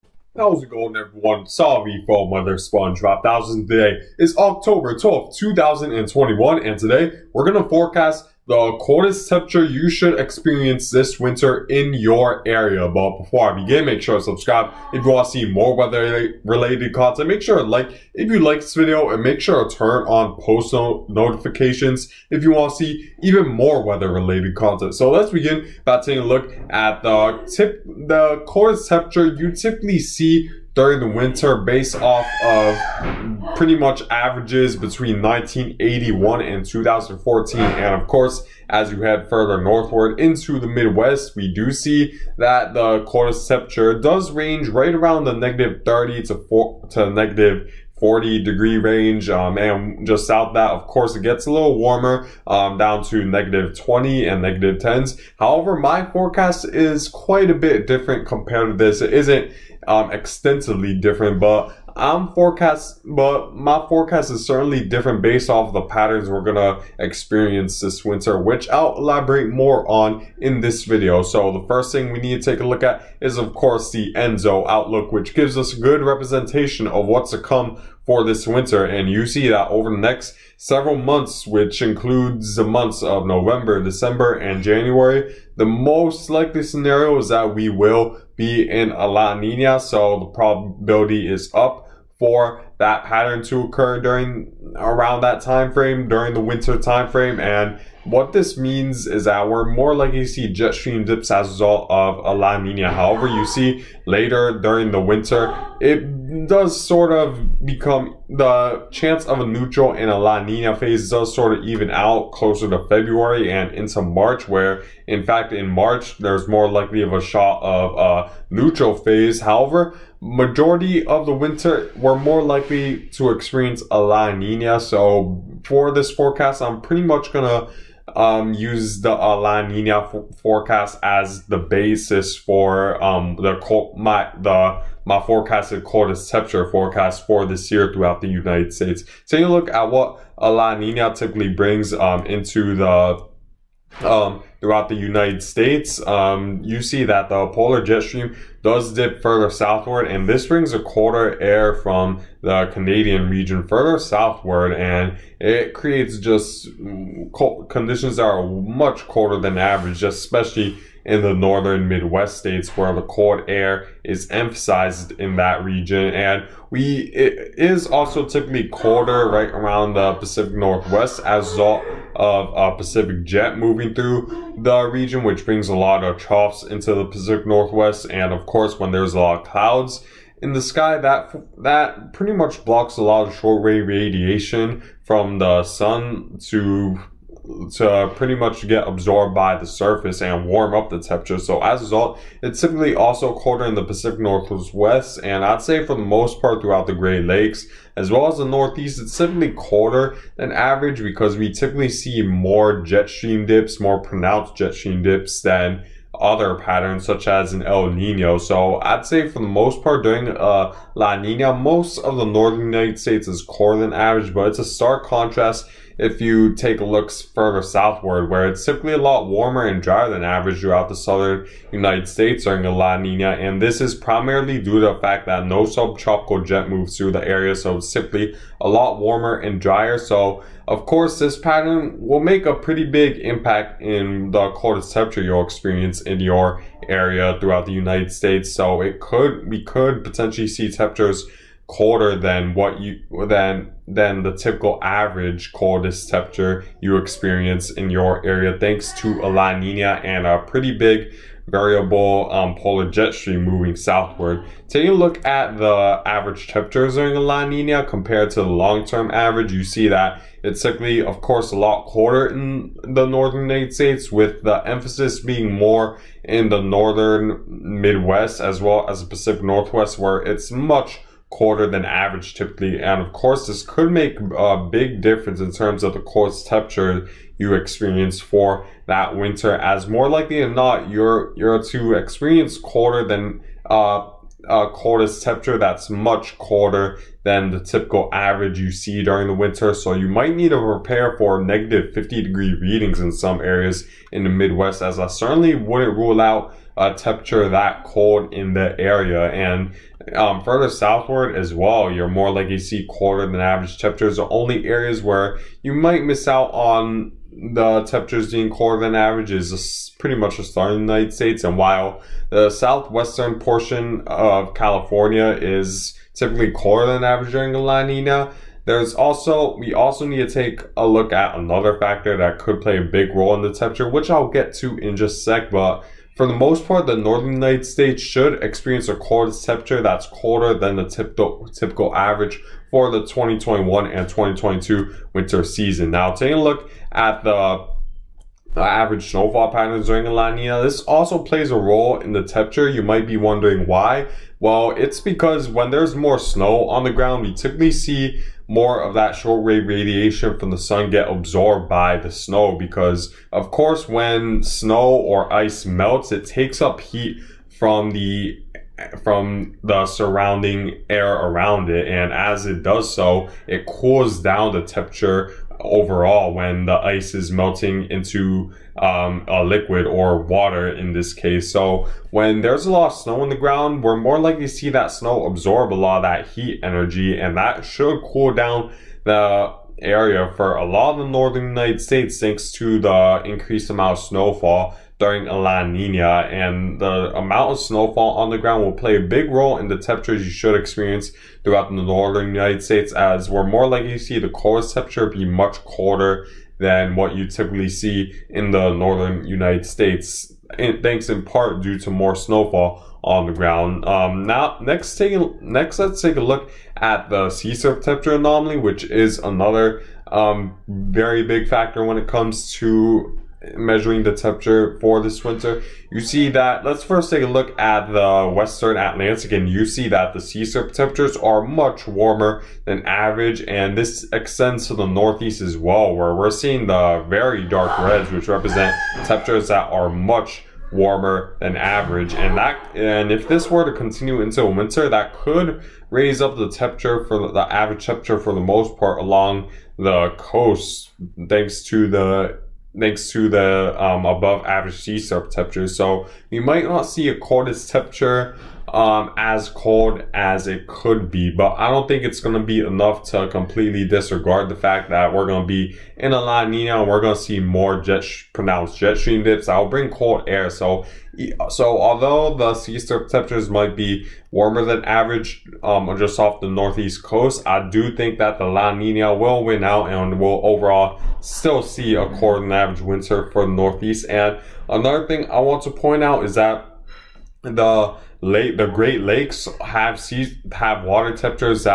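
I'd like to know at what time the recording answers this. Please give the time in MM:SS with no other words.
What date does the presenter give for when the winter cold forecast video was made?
00:04.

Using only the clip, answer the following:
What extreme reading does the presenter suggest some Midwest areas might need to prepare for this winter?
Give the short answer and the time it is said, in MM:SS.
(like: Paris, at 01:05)
-50 degrees, at 04:51.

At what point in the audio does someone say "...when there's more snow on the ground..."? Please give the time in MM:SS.
05:45.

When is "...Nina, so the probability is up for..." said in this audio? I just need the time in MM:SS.
01:29.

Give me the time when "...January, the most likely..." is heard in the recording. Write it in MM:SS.
01:24.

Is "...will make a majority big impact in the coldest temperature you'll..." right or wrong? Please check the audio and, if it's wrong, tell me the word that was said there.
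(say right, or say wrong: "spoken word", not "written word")
wrong: "pretty", not "majority".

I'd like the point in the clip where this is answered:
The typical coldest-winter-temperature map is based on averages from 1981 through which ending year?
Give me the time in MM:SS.
00:36.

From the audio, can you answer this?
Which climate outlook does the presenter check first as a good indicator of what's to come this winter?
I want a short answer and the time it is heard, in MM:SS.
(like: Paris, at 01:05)
ENSO outlook, at 01:14.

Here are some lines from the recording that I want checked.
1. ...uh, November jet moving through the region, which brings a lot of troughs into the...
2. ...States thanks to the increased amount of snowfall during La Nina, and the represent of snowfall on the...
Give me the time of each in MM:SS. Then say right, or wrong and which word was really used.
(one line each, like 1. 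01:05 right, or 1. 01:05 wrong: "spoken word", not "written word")
1. 02:52 wrong: "Pacific", not "November"
2. 06:21 wrong: "amount", not "represent".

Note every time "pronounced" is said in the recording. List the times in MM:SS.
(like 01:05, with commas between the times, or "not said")
03:24, 07:38.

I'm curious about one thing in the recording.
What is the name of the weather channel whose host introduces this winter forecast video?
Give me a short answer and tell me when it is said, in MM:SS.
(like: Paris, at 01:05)
Weather Sponge Five Thousand, at 00:02.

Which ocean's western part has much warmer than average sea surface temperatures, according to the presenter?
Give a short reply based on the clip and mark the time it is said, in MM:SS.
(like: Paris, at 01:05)
Atlantic, at 06:58.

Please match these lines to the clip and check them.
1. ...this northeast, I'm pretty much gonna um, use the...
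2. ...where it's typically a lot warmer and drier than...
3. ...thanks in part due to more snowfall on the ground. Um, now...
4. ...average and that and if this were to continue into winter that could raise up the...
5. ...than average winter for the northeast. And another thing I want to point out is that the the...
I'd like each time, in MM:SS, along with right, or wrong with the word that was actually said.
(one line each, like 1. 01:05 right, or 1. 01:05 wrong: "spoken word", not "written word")
1. 02:05 wrong: "forecast", not "northeast"
2. 03:38 right
3. 06:40 right
4. 07:11 right
5. 07:52 right.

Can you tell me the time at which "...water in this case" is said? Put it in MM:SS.
06:10.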